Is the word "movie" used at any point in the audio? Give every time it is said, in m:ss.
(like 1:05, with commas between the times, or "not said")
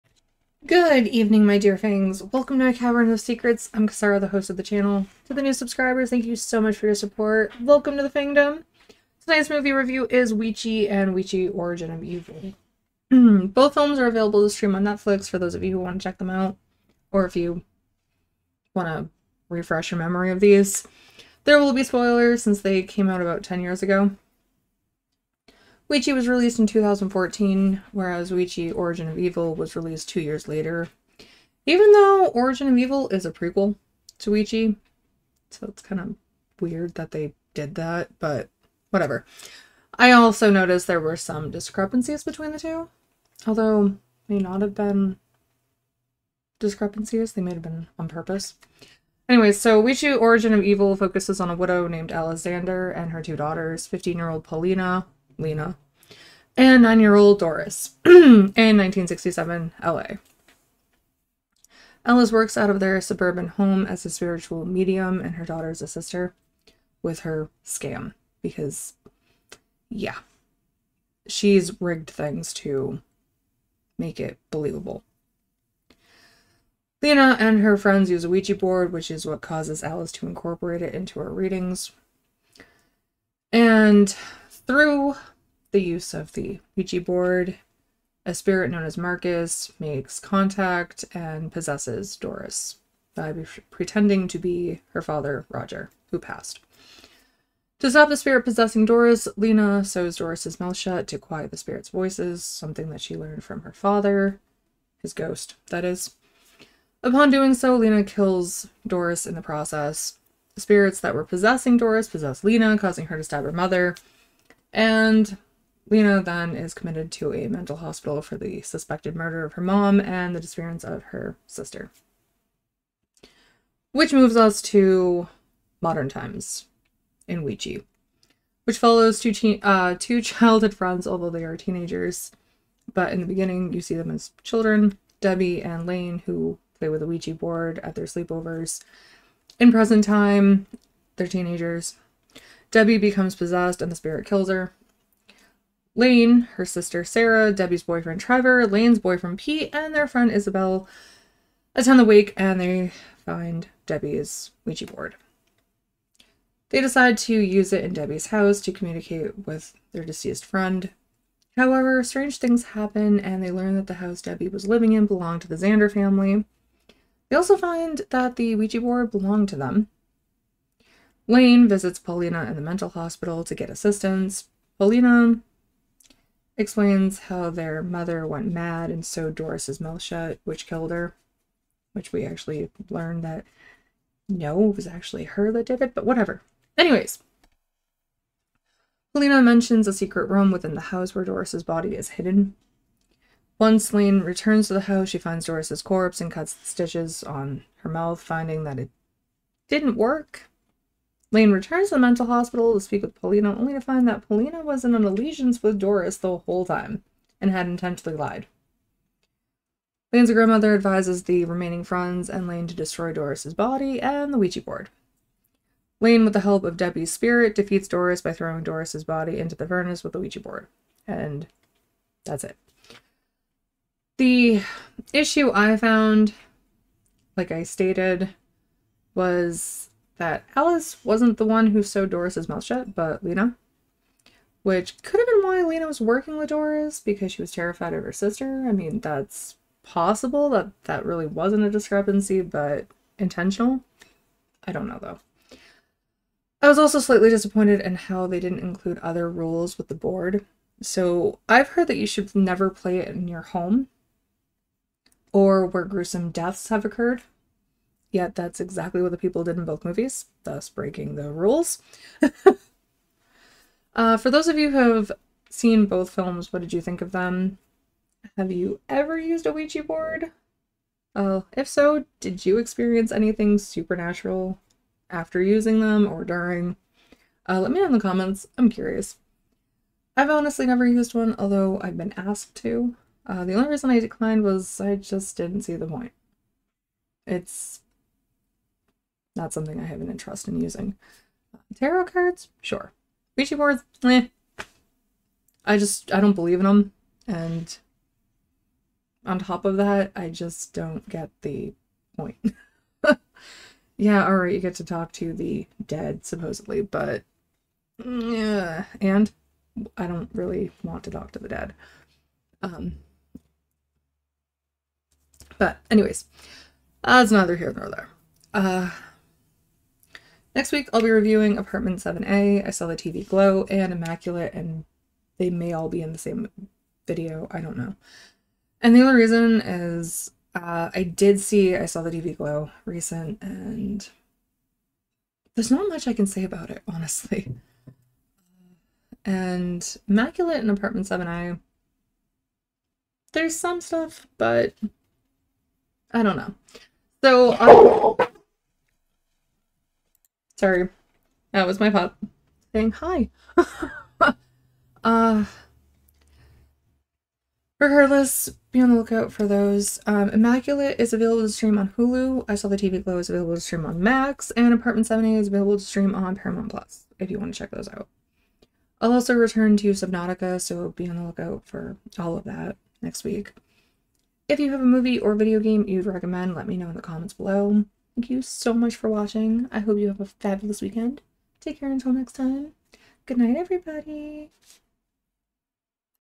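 0:09, 4:19, 6:14.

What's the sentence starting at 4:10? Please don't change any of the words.
So I've heard that you should never play it in your home or where gruesome deaths have occurred.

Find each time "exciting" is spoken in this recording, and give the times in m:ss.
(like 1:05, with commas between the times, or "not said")
not said.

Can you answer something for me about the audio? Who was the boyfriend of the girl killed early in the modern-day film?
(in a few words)
Trevor.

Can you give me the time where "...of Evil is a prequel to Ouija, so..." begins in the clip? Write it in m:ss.
0:32.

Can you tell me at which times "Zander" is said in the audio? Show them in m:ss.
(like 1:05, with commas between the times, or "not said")
0:52, 2:45.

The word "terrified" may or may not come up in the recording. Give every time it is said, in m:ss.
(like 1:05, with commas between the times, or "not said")
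3:57.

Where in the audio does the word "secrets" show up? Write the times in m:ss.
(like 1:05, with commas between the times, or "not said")
0:03, 3:09.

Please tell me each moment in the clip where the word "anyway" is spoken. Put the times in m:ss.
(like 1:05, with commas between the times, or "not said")
0:49, 3:06, 5:15.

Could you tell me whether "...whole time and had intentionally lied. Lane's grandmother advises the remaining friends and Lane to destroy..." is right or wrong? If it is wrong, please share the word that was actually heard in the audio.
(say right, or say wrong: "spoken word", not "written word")
right.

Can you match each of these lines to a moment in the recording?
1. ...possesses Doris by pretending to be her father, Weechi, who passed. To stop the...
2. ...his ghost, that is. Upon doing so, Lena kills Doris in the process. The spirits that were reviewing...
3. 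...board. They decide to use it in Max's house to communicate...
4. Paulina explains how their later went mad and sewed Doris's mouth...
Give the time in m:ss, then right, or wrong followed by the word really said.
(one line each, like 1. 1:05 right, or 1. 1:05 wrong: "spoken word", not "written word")
1. 1:31 wrong: "Roger", not "Weechi"
2. 1:45 wrong: "possessing", not "reviewing"
3. 2:34 wrong: "Debbie", not "Max"
4. 2:54 wrong: "mother", not "later".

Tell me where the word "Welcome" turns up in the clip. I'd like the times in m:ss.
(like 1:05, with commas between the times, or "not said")
0:02, 0:07.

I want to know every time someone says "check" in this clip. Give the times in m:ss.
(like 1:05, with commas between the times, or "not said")
0:16, 6:07.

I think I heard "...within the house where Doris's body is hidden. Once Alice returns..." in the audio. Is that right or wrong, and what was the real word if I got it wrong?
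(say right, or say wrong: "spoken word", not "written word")
wrong: "Lane", not "Alice".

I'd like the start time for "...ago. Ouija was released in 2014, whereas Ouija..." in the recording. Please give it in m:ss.
0:23.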